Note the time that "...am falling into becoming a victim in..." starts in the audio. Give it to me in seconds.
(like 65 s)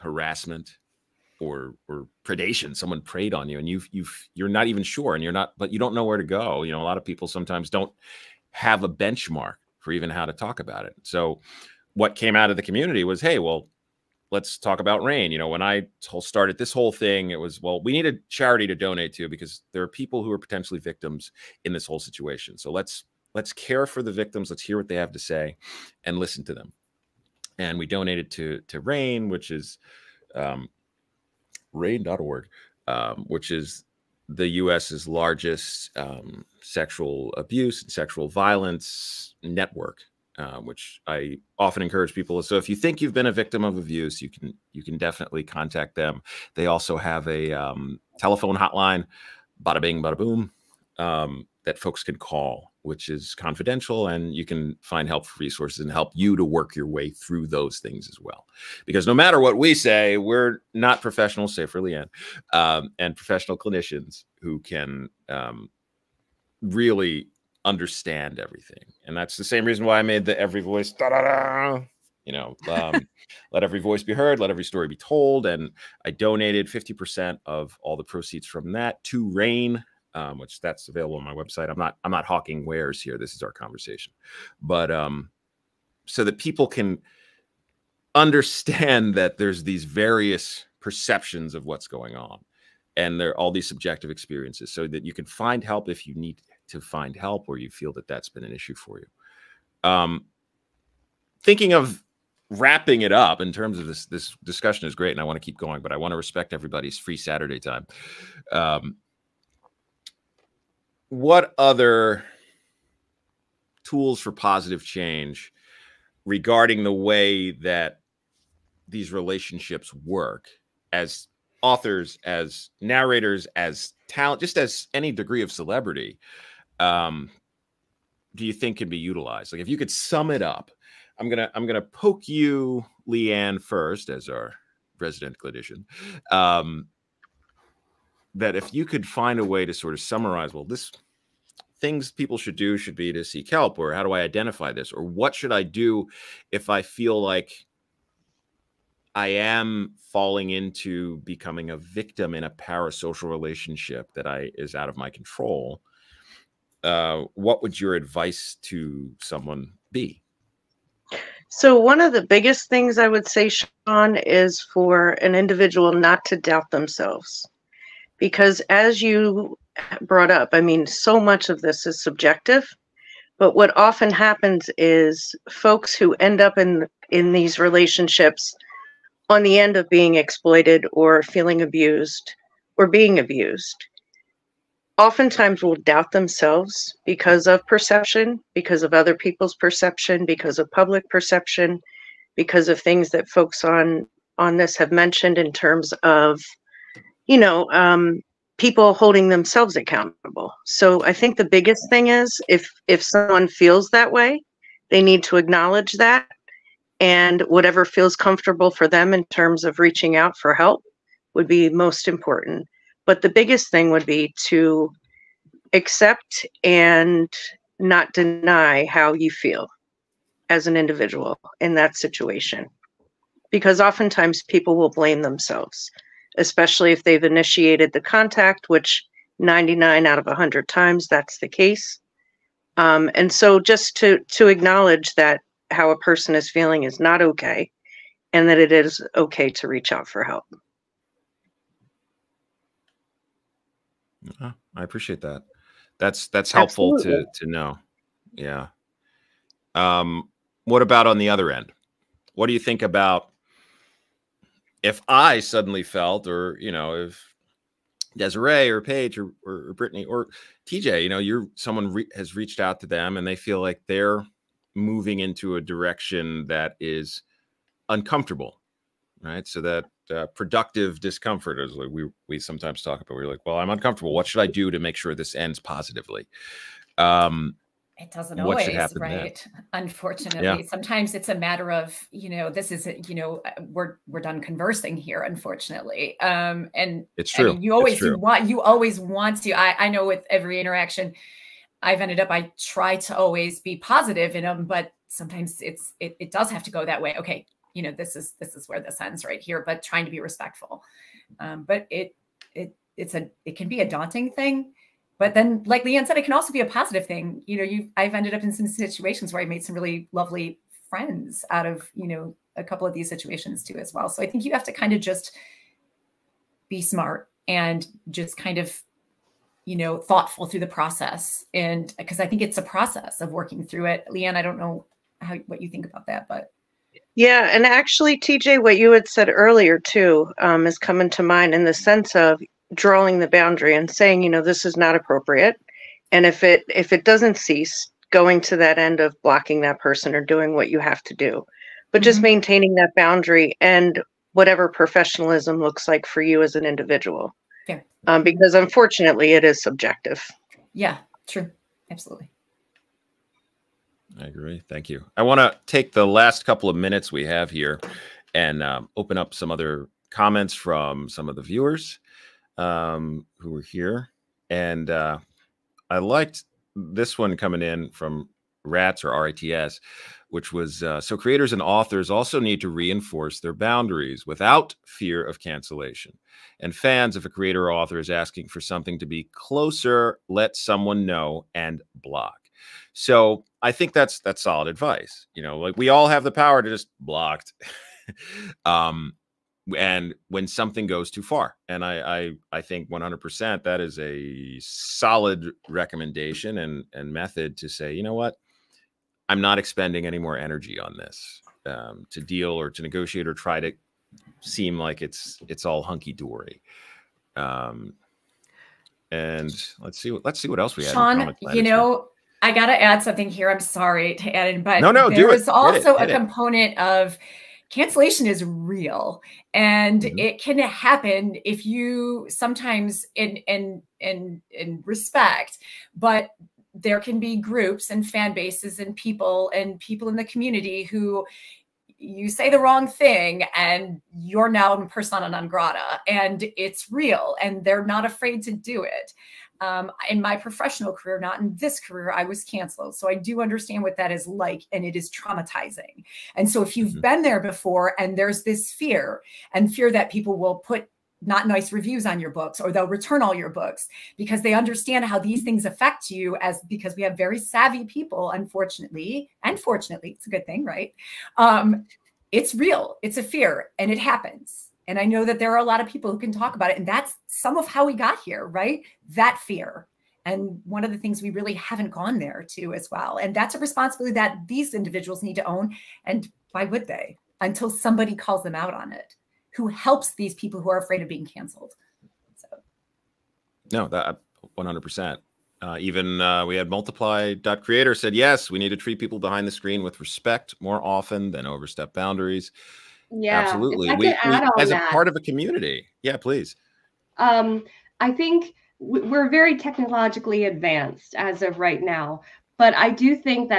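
149 s.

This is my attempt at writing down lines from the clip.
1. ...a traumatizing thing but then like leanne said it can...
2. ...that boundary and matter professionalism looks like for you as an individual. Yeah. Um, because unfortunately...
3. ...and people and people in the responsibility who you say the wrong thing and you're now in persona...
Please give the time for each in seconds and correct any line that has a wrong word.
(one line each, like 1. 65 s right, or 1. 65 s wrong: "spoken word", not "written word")
1. 303 s wrong: "daunting", not "traumatizing"
2. 342 s wrong: "whatever", not "matter"
3. 428 s wrong: "community", not "responsibility".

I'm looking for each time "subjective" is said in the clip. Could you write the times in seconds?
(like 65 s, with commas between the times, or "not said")
93 s, 172 s, 349 s.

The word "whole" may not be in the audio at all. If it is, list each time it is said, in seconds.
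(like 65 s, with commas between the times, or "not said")
16 s, 21 s.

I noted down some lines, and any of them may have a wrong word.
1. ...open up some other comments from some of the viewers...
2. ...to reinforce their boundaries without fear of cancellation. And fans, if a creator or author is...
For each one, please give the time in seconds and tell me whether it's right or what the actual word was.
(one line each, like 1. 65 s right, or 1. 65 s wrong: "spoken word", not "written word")
1. 358 s right
2. 372 s right.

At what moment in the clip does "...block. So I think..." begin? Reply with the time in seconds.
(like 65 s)
381 s.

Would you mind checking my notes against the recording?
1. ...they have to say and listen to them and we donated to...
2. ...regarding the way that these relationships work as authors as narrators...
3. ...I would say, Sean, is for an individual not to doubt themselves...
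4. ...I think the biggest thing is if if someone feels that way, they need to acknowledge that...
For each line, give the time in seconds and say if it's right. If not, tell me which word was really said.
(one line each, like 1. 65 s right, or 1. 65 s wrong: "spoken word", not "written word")
1. 24 s right
2. 116 s right
3. 162 s right
4. 201 s right.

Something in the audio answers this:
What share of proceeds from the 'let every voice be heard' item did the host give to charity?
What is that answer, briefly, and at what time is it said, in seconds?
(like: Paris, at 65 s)
50%, at 76 s.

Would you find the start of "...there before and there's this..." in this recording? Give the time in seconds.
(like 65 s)
447 s.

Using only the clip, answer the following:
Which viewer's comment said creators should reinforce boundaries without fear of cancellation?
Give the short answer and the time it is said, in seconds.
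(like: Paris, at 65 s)
RATS, at 368 s.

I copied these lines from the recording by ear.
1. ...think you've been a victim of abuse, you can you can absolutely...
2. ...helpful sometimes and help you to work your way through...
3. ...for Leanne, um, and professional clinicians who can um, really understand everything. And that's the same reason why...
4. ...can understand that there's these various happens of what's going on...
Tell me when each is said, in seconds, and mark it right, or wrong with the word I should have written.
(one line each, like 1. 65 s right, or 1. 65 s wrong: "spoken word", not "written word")
1. 42 s wrong: "definitely", not "absolutely"
2. 55 s wrong: "resources", not "sometimes"
3. 61 s right
4. 86 s wrong: "perceptions", not "happens".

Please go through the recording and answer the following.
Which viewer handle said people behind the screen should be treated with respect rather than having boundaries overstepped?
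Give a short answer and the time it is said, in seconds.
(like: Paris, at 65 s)
multiply.creator, at 486 s.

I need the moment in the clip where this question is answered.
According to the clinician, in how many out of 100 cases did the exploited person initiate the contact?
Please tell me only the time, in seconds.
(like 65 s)
229 s.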